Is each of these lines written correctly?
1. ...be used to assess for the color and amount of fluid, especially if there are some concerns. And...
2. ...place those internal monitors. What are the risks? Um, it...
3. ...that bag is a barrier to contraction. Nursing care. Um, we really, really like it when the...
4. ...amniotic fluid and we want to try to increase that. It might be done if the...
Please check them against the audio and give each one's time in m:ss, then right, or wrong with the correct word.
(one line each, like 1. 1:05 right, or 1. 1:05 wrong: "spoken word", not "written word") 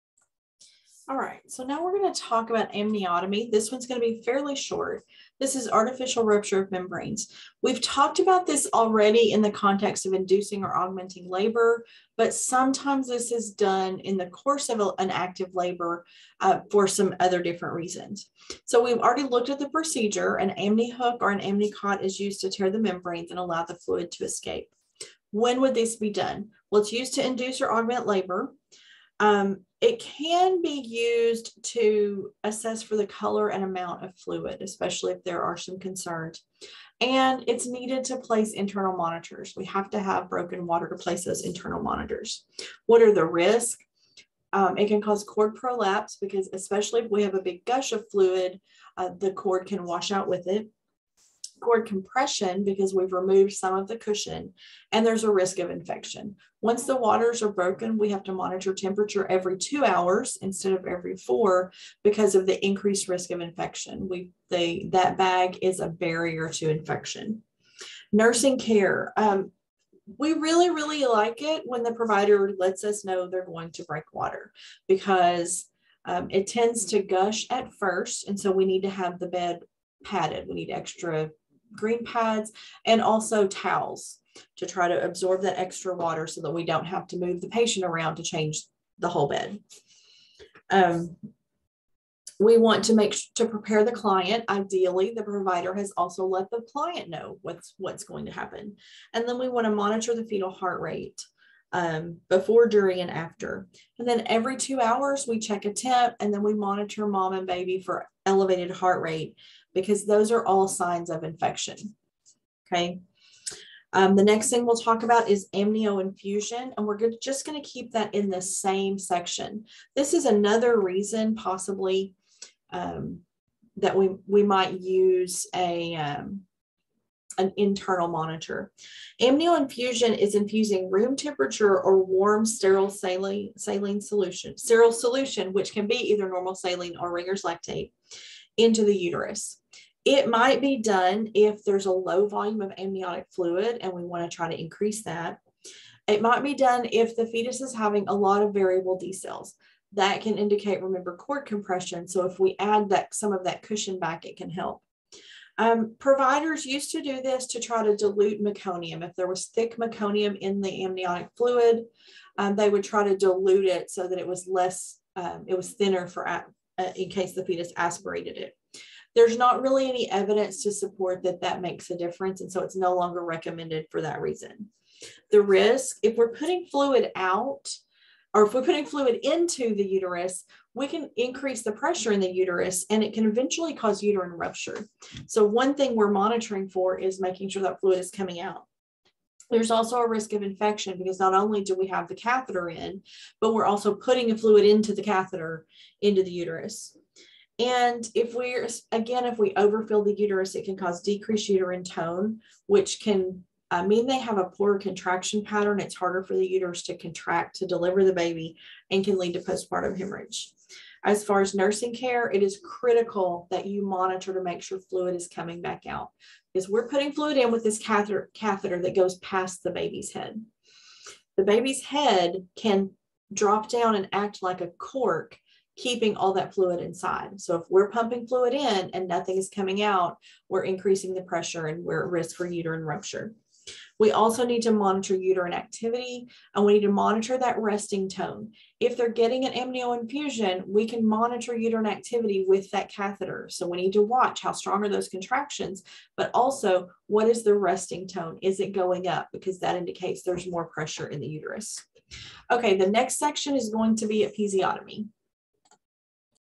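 1. 0:30 right
2. 0:40 right
3. 1:04 wrong: "infection", not "contraction"
4. 2:22 right.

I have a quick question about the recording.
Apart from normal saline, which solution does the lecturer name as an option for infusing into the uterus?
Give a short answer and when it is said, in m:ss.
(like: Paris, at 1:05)
Ringer's lactate, at 2:17.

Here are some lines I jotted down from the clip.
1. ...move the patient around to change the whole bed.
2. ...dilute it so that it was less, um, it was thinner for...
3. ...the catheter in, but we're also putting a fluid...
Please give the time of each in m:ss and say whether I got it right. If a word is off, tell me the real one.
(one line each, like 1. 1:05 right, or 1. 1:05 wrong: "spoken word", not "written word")
1. 1:27 right
2. 2:43 right
3. 3:12 right.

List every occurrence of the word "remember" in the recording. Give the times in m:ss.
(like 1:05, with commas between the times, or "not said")
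2:30.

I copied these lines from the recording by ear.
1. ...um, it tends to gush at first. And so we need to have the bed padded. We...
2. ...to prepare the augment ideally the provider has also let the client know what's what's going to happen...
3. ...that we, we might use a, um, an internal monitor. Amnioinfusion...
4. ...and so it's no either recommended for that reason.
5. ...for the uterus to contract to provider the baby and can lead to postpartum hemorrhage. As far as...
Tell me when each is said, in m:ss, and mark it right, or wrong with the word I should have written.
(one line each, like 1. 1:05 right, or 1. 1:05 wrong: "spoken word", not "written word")
1. 1:16 right
2. 1:33 wrong: "client", not "augment"
3. 2:03 right
4. 2:52 wrong: "longer", not "either"
5. 3:26 wrong: "deliver", not "provider".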